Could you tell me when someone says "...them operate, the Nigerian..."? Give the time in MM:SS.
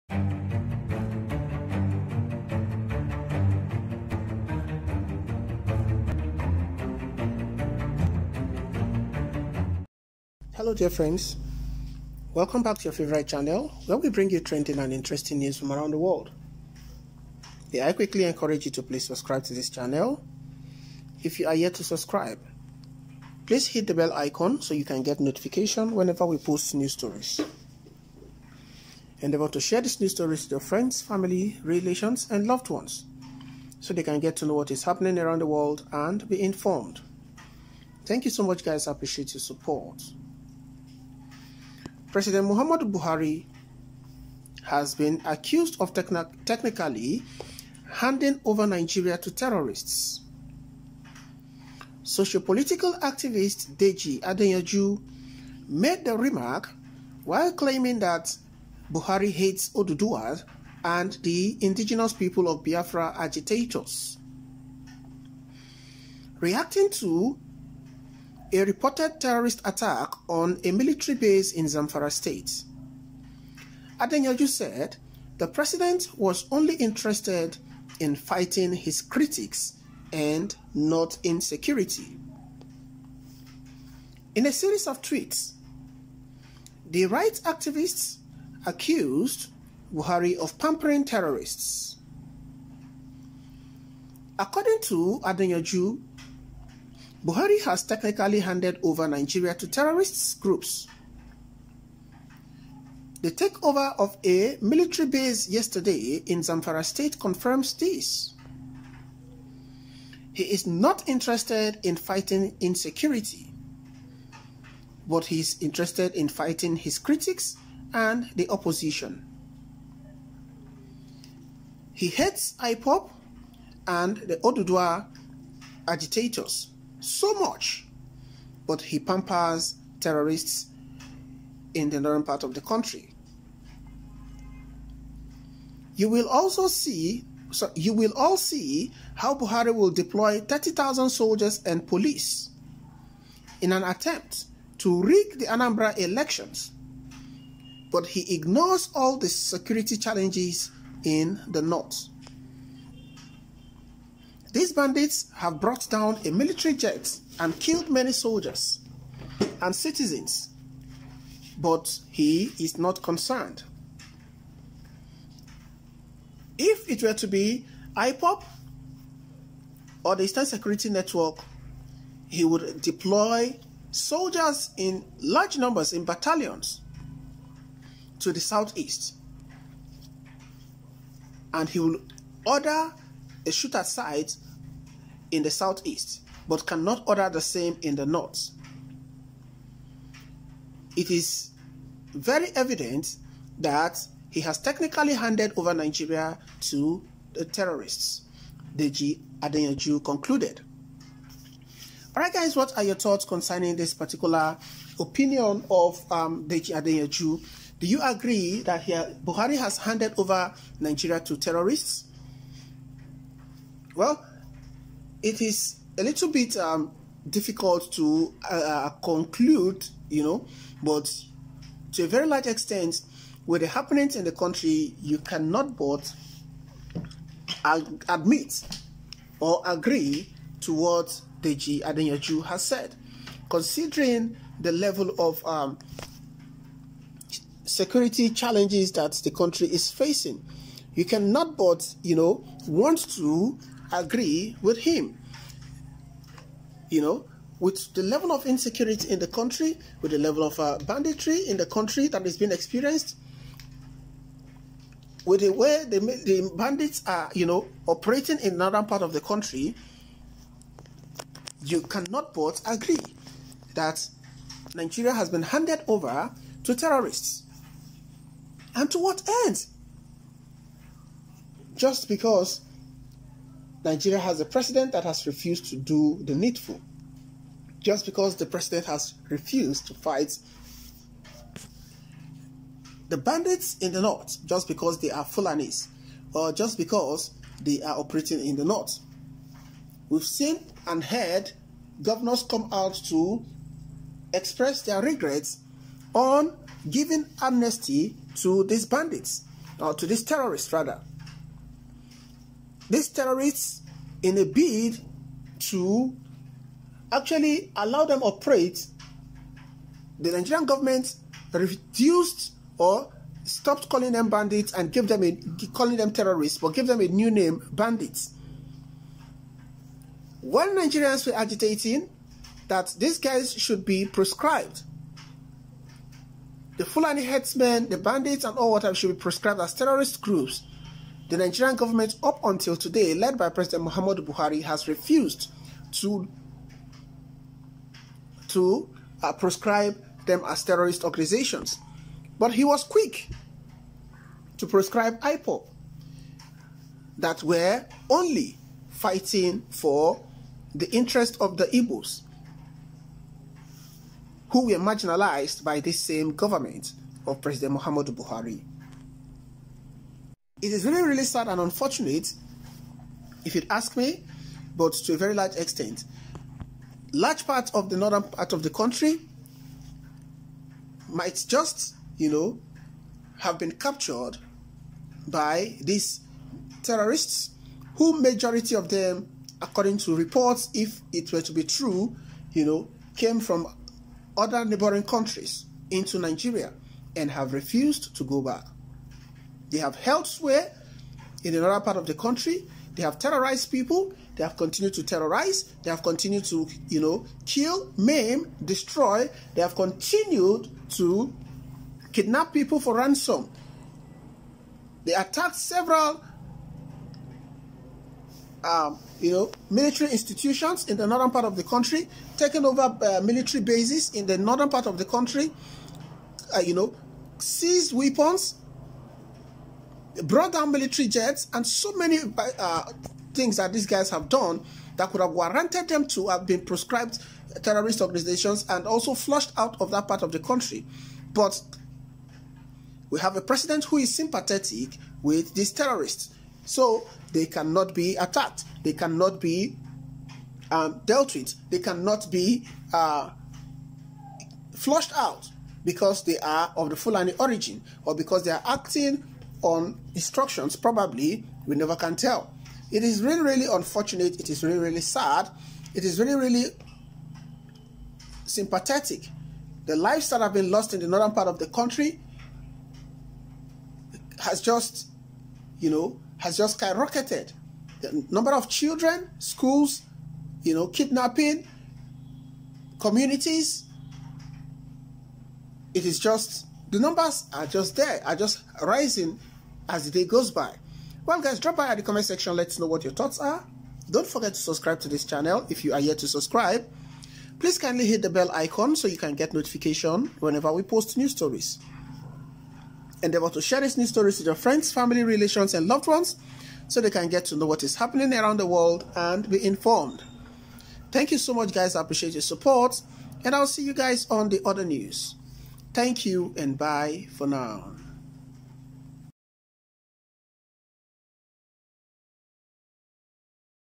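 05:08.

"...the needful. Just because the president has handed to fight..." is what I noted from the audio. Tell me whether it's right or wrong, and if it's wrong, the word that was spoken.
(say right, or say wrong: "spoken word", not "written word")
wrong: "refused", not "handed".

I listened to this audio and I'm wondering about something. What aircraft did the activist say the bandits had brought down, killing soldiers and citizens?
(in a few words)
military jet.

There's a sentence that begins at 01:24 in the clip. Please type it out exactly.
In a series of tweets, the rights activists accused Buhari of pampering terrorists.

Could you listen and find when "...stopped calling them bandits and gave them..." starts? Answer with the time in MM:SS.
05:13.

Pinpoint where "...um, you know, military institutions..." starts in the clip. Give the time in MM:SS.
06:48.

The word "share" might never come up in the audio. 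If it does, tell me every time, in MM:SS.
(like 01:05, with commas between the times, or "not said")
00:29, 08:13.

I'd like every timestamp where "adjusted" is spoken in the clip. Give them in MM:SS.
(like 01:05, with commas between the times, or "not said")
not said.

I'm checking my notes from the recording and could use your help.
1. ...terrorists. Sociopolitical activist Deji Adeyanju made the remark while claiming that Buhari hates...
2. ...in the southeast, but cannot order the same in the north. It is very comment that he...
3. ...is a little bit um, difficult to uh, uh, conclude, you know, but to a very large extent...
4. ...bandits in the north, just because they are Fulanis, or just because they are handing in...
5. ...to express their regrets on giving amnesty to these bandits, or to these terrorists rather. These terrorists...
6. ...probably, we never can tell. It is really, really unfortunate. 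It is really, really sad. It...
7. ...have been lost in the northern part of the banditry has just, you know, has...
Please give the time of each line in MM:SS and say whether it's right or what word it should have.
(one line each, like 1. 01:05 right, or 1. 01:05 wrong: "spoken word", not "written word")
1. 00:49 right
2. 03:05 wrong: "evident", not "comment"
3. 03:35 right
4. 04:43 wrong: "operating", not "handing"
5. 04:53 right
6. 07:30 right
7. 07:40 wrong: "country", not "banditry".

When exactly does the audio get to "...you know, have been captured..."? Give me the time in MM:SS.
06:12.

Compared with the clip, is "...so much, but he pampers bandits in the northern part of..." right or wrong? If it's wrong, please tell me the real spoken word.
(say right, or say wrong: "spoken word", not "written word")
wrong: "terrorists", not "bandits".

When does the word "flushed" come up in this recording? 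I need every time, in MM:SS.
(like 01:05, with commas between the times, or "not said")
07:09, 07:24.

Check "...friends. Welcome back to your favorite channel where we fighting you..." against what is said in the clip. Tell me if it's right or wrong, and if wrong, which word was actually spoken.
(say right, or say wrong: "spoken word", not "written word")
wrong: "bring", not "fighting".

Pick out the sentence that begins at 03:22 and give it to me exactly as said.
Alright guys, what are your thoughts concerning this particular opinion of um, Deji Adeyanju?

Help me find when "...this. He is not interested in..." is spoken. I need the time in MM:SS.
01:47.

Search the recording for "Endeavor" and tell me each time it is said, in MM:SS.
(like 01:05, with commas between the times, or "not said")
00:29, 08:13.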